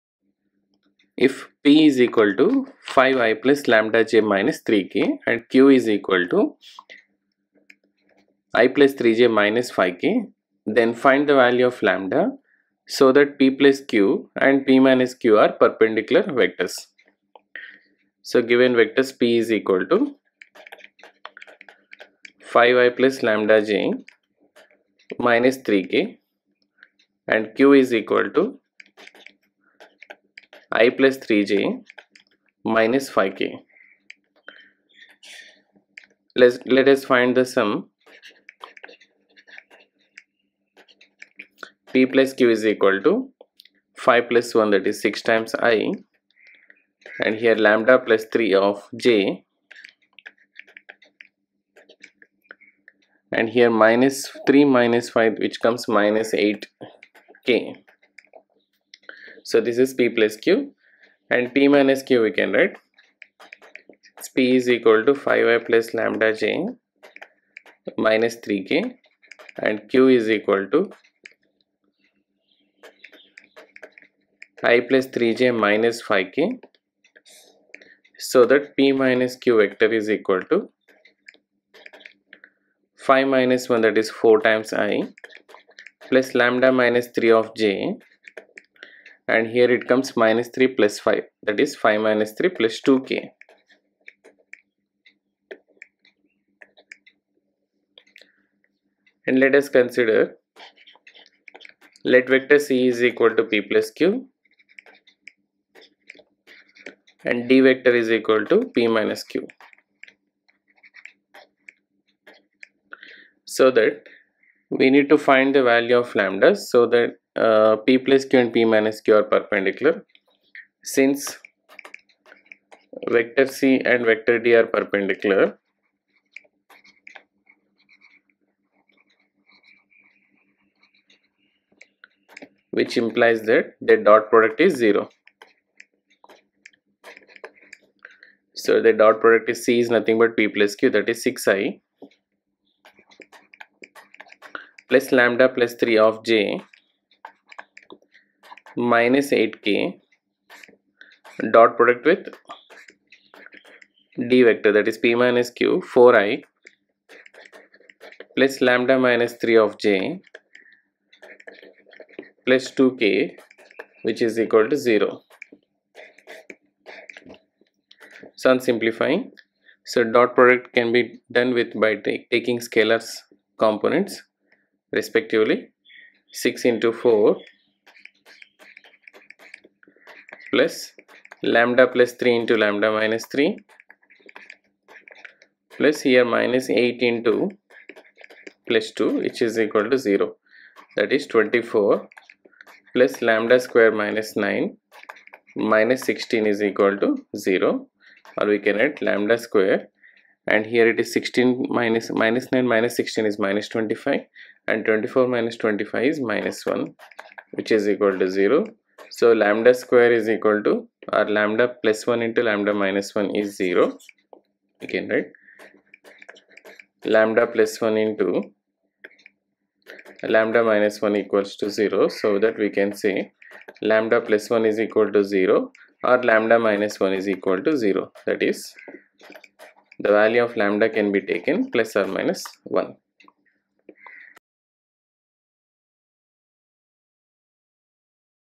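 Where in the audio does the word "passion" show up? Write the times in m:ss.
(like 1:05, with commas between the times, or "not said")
not said.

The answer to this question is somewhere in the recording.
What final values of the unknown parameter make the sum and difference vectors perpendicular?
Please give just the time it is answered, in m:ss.
3:51.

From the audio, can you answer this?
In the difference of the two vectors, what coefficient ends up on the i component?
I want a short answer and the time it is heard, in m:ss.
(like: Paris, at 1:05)
4, at 1:24.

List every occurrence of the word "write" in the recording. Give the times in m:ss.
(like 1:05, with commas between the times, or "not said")
1:02, 3:18.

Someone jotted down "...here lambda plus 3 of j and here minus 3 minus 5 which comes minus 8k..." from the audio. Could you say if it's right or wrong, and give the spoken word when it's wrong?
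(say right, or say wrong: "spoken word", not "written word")
right.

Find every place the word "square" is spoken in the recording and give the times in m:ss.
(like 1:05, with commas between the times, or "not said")
3:13, 3:19, 3:29.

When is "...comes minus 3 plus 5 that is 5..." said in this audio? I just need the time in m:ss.
1:29.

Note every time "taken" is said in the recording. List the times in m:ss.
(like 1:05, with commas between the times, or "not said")
3:51.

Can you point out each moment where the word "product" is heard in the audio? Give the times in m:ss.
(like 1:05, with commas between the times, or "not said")
2:14, 2:19, 2:31, 2:50.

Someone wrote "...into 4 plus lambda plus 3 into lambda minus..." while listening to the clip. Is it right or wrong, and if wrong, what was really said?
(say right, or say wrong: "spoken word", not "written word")
right.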